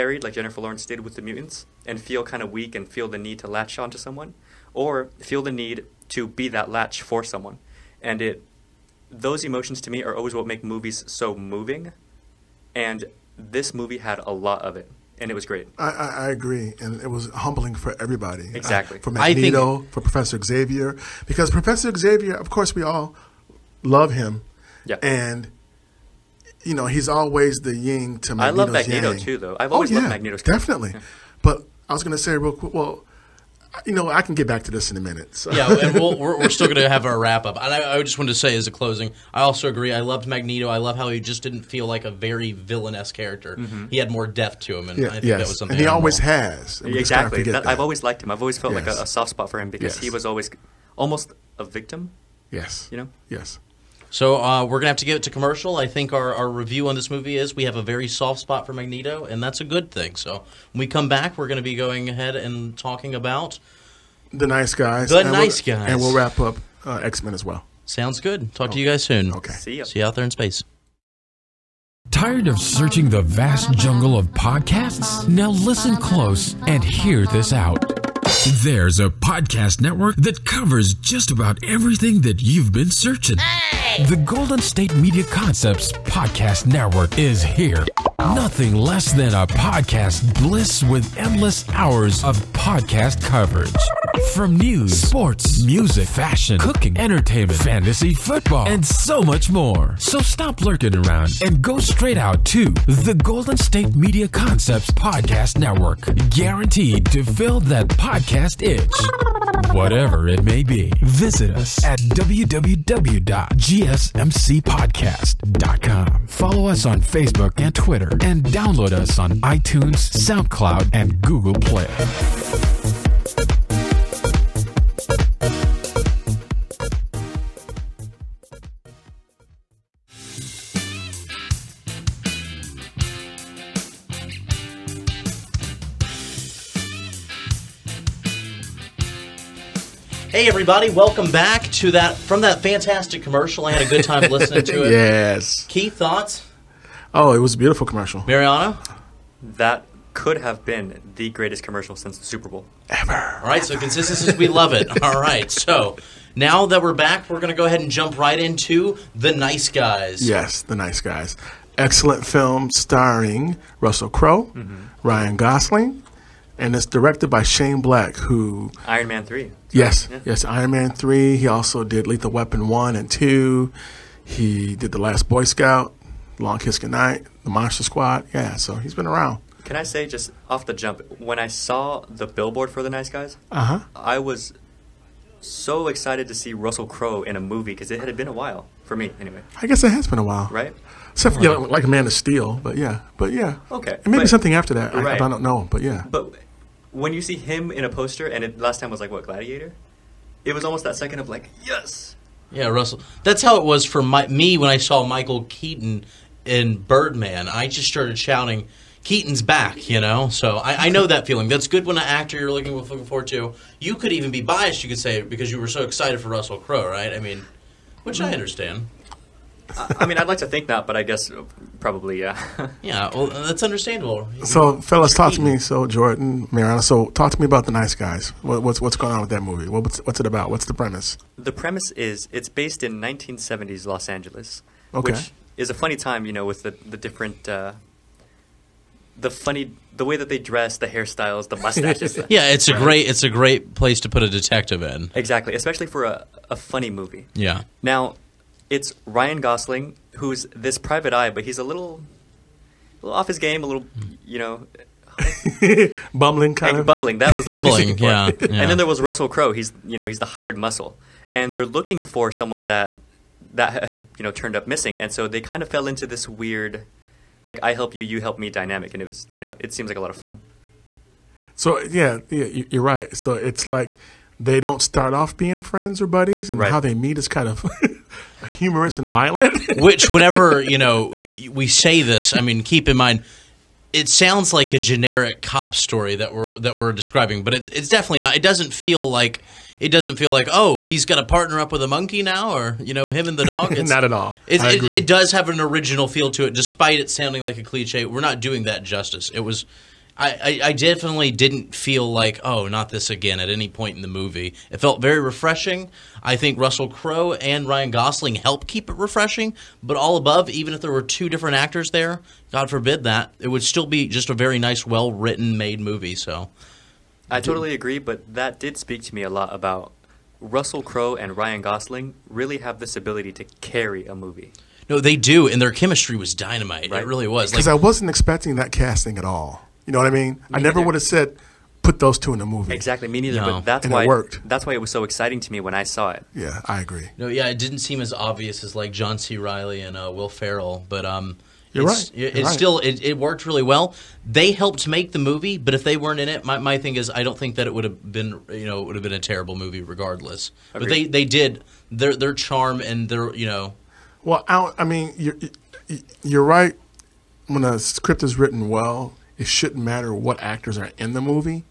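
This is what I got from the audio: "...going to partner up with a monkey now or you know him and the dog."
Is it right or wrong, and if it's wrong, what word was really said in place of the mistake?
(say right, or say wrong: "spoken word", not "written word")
right.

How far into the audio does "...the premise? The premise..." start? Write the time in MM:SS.
03:50.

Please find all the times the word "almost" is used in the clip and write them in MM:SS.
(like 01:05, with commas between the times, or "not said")
00:50, 03:20.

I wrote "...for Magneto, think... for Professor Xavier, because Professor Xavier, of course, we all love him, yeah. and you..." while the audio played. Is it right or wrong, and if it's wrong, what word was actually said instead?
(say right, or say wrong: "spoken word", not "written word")
right.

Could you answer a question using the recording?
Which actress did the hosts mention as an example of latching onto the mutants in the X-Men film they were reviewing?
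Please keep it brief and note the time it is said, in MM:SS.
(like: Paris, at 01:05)
Jennifer Lawrence, at 00:00.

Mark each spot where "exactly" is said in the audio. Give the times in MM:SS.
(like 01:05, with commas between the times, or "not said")
00:18, 00:46, 04:05, 05:32.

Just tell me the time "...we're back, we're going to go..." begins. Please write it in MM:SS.
02:36.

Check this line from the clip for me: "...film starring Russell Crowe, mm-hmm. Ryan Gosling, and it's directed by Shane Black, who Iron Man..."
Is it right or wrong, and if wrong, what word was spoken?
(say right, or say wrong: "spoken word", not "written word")
right.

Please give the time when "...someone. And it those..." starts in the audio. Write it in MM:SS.
00:07.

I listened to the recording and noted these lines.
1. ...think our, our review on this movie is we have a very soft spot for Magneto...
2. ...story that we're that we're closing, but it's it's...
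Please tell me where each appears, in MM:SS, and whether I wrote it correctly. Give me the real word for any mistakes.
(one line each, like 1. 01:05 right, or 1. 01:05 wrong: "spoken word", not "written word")
1. 00:55 right
2. 04:45 wrong: "describing", not "closing".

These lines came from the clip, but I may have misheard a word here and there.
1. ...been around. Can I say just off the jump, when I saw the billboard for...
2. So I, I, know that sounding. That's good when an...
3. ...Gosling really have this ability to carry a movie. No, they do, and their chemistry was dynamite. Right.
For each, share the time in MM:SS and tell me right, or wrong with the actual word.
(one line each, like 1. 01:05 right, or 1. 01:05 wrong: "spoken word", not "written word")
1. 02:58 right
2. 03:30 wrong: "feeling", not "sounding"
3. 05:21 right.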